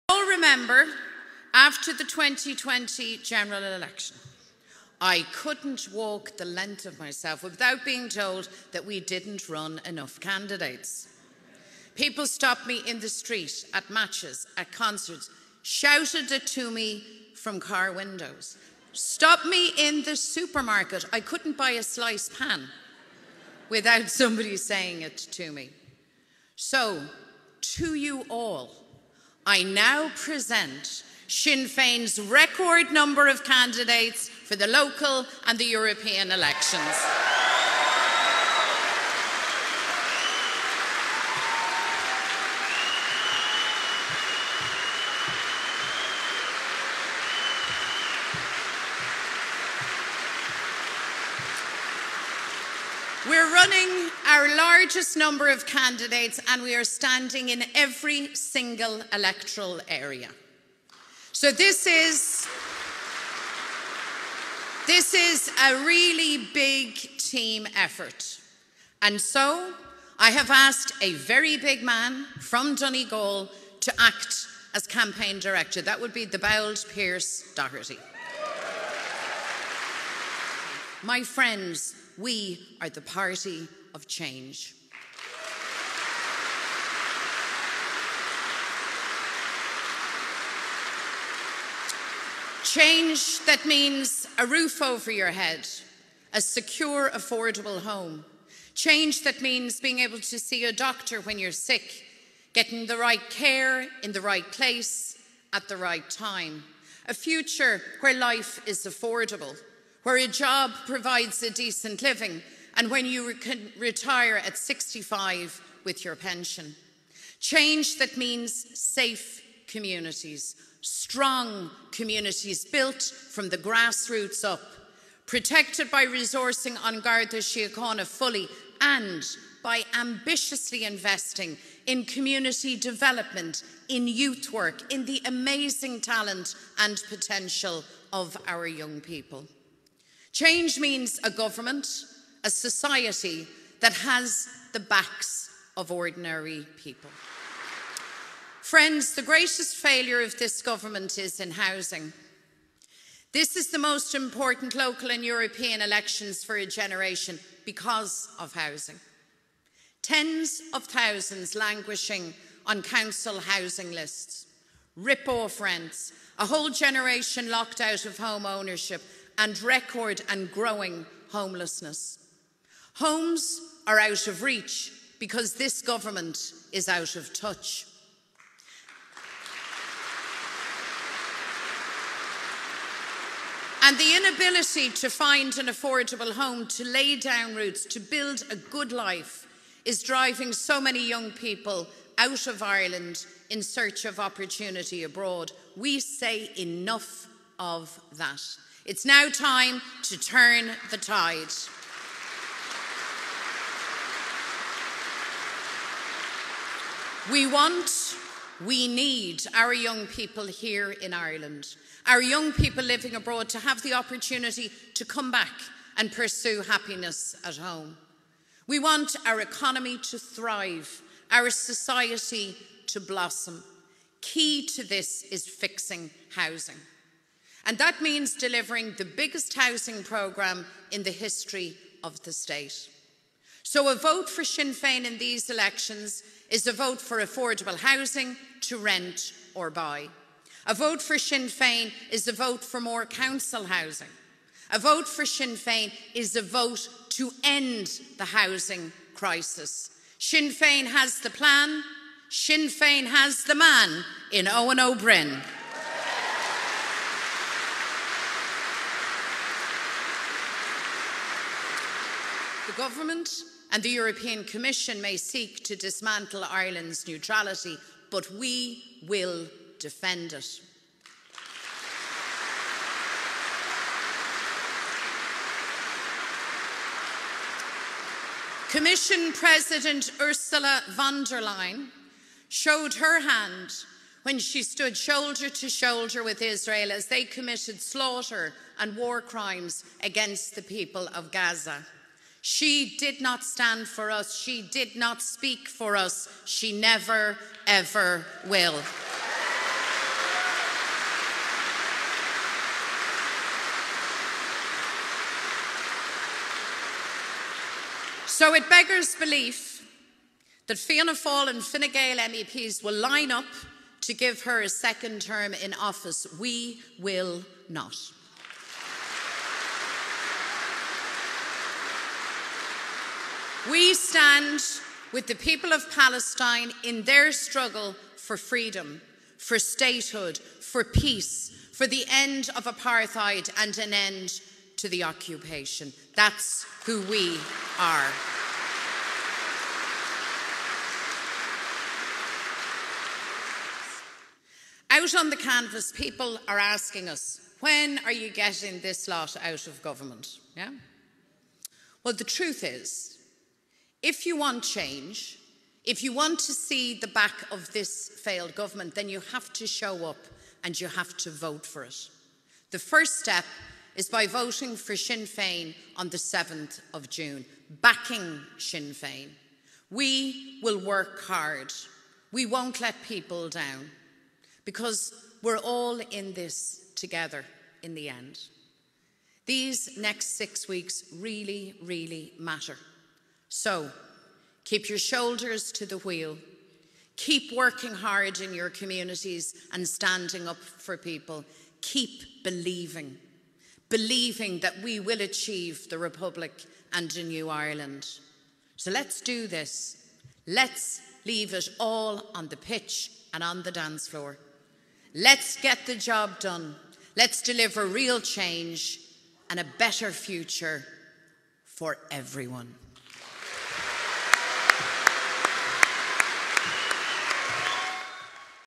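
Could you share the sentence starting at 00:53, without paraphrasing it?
We're running our largest number of candidates and we are standing in every single electoral area.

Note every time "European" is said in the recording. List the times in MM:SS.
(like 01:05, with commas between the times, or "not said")
00:35, 02:35, 04:23.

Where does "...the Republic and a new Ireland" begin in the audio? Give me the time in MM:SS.
06:35.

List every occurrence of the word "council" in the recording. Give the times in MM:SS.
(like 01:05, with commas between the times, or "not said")
02:42, 04:03.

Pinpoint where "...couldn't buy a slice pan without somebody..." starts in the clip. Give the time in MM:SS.
00:21.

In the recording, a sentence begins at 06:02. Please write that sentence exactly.
The first step is by voting for Sinn Féin on the 7th of June, backing Sinn Féin.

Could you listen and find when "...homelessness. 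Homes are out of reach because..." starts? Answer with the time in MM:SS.
02:51.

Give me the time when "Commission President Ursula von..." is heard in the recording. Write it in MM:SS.
04:38.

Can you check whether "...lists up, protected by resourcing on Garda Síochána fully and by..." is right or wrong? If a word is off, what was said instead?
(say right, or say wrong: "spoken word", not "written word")
wrong: "grassroots", not "lists".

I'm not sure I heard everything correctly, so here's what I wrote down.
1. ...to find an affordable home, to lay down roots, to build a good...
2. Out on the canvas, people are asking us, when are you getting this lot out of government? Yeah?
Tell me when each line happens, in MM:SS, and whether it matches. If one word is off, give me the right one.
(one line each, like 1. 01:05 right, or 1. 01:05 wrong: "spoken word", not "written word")
1. 03:04 right
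2. 05:44 right.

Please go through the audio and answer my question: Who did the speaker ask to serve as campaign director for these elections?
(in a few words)
Pearse Doherty.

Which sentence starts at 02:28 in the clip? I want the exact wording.
Friends, the greatest failure of this government is in housing.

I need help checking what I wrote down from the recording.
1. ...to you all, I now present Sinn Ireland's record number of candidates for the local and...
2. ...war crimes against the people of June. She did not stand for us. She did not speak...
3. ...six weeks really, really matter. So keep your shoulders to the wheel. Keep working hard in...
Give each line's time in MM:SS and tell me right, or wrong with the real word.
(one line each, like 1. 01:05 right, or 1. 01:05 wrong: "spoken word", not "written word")
1. 00:27 wrong: "Féin", not "Ireland"
2. 04:48 wrong: "Gaza", not "June"
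3. 06:20 right.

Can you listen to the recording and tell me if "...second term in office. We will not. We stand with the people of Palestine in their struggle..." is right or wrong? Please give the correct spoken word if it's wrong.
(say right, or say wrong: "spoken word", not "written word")
right.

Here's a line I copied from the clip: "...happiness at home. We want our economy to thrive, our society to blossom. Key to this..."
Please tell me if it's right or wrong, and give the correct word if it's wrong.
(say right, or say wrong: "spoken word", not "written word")
right.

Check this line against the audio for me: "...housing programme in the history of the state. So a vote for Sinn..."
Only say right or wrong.
right.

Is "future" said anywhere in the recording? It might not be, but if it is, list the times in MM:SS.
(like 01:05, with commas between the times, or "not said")
01:47, 06:50.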